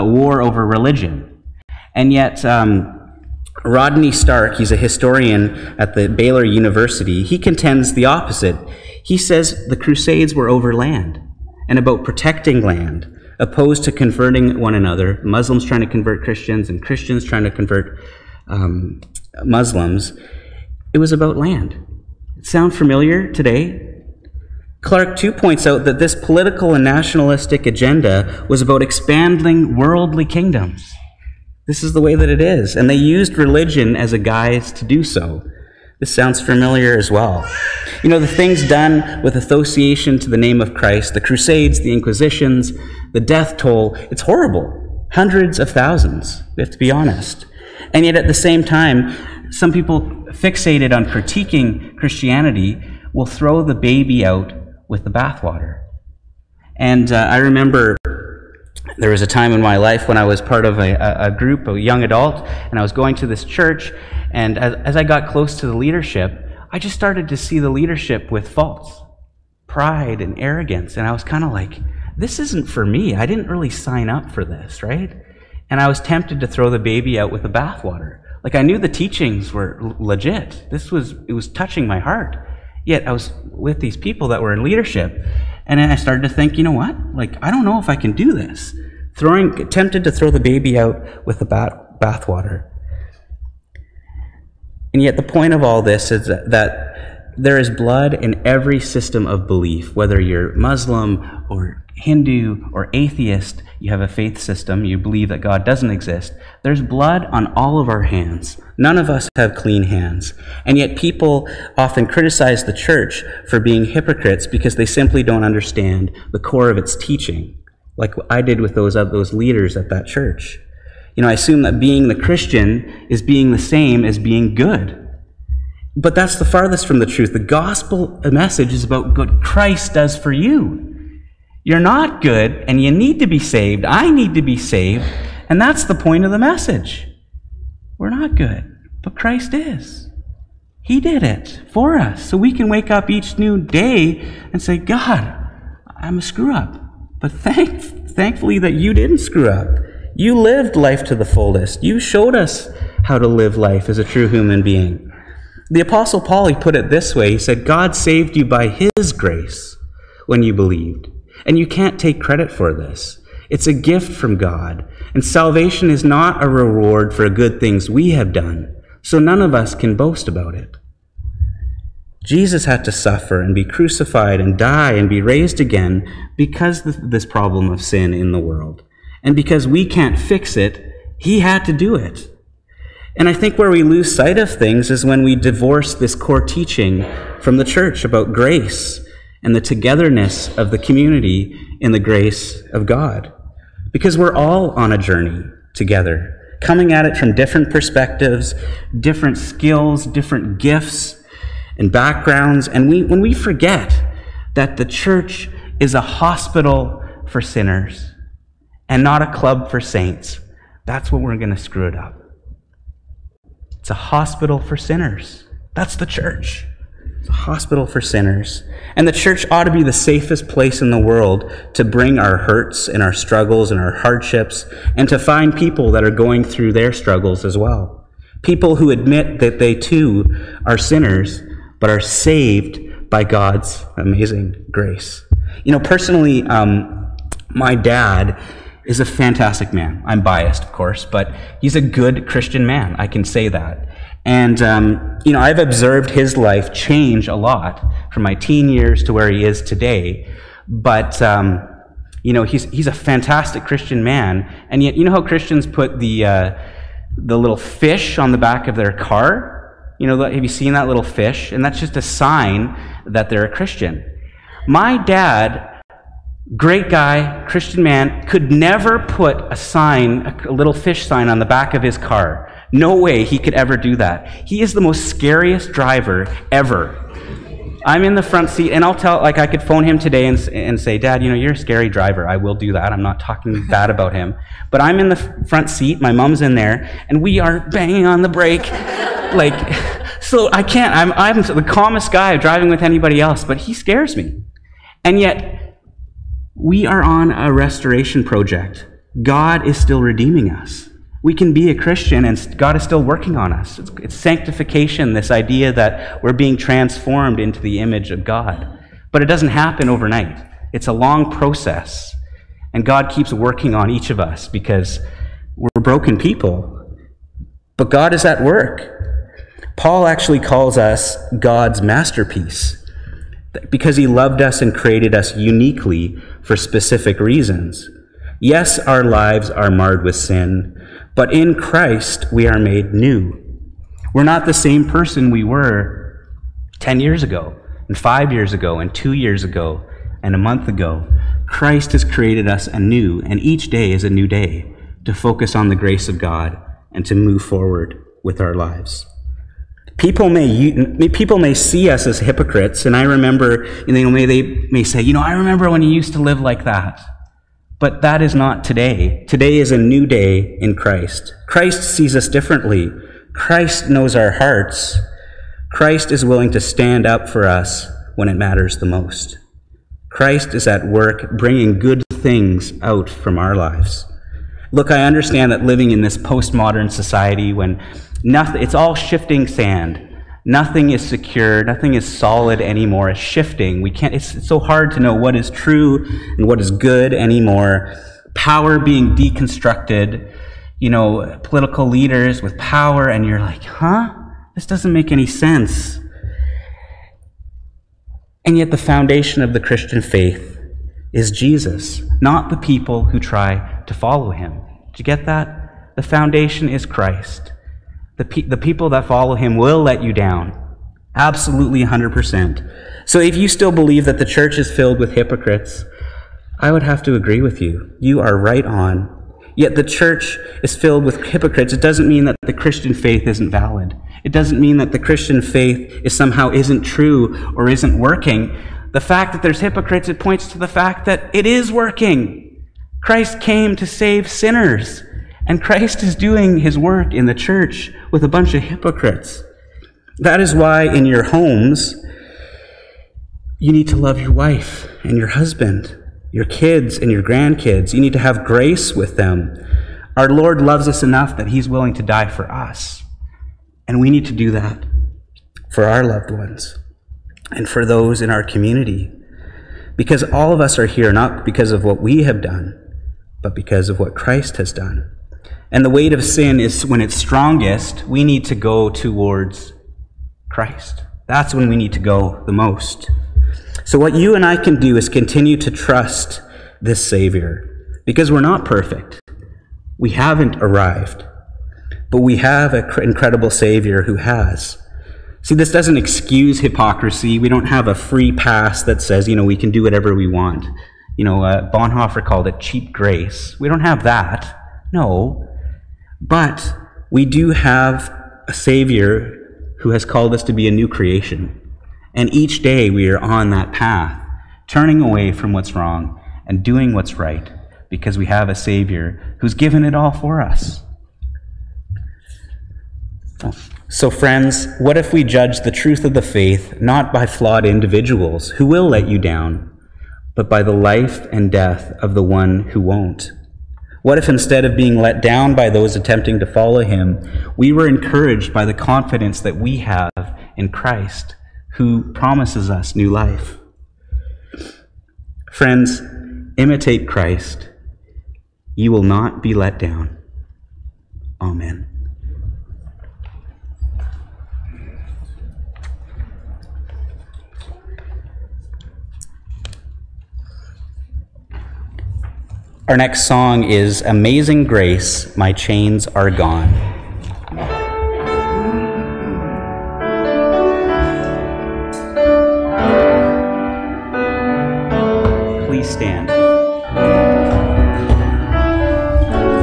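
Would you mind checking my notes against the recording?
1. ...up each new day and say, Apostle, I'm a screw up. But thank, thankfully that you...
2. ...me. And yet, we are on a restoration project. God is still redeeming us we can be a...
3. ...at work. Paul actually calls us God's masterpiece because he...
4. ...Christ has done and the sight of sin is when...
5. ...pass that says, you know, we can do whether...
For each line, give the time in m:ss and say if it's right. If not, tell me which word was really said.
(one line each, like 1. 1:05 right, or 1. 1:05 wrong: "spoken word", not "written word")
1. 2:22 wrong: "God", not "Apostle"
2. 4:54 right
3. 5:18 right
4. 7:44 wrong: "weight", not "sight"
5. 8:08 wrong: "whatever", not "whether".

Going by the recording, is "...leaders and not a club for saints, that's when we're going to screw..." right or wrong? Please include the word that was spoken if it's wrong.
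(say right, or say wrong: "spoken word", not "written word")
wrong: "sinners", not "leaders".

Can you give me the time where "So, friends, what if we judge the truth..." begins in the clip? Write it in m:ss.
8:33.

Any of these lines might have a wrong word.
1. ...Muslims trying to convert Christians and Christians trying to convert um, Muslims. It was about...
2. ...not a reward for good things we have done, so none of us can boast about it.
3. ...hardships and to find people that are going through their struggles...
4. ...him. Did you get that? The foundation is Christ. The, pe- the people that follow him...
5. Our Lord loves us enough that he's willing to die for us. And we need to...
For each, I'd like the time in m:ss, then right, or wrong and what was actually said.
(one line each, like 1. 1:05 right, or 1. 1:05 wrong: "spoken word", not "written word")
1. 0:15 right
2. 2:46 right
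3. 3:43 right
4. 6:44 right
5. 7:30 right.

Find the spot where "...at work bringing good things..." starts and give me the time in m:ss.
6:10.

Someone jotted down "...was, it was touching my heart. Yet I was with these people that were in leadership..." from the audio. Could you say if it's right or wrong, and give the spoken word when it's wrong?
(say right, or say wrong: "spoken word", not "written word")
right.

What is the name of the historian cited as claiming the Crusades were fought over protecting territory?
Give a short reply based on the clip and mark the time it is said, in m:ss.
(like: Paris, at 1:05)
Rodney Stark, at 0:03.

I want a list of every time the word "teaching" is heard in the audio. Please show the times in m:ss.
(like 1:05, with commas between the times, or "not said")
1:18, 1:56, 3:06.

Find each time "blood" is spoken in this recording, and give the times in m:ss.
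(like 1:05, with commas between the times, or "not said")
1:37, 1:46.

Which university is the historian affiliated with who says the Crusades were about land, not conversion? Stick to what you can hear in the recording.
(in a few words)
Baylor University.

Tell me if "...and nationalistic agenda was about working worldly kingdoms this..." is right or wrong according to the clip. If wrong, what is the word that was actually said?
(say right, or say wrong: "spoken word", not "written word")
wrong: "expanding", not "working".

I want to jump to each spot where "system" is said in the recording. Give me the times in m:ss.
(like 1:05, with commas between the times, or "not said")
1:38, 1:44.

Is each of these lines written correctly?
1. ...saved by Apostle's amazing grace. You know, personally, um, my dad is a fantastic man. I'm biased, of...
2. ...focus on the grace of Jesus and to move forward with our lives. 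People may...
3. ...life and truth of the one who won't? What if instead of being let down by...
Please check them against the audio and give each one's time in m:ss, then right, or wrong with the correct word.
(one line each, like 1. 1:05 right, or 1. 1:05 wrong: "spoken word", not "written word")
1. 3:52 wrong: "God", not "Apostle"
2. 5:45 wrong: "God", not "Jesus"
3. 8:40 wrong: "death", not "truth".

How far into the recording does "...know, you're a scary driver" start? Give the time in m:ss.
4:41.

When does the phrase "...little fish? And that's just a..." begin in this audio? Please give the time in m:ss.
4:20.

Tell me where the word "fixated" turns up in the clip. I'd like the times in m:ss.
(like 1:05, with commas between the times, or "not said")
0:50.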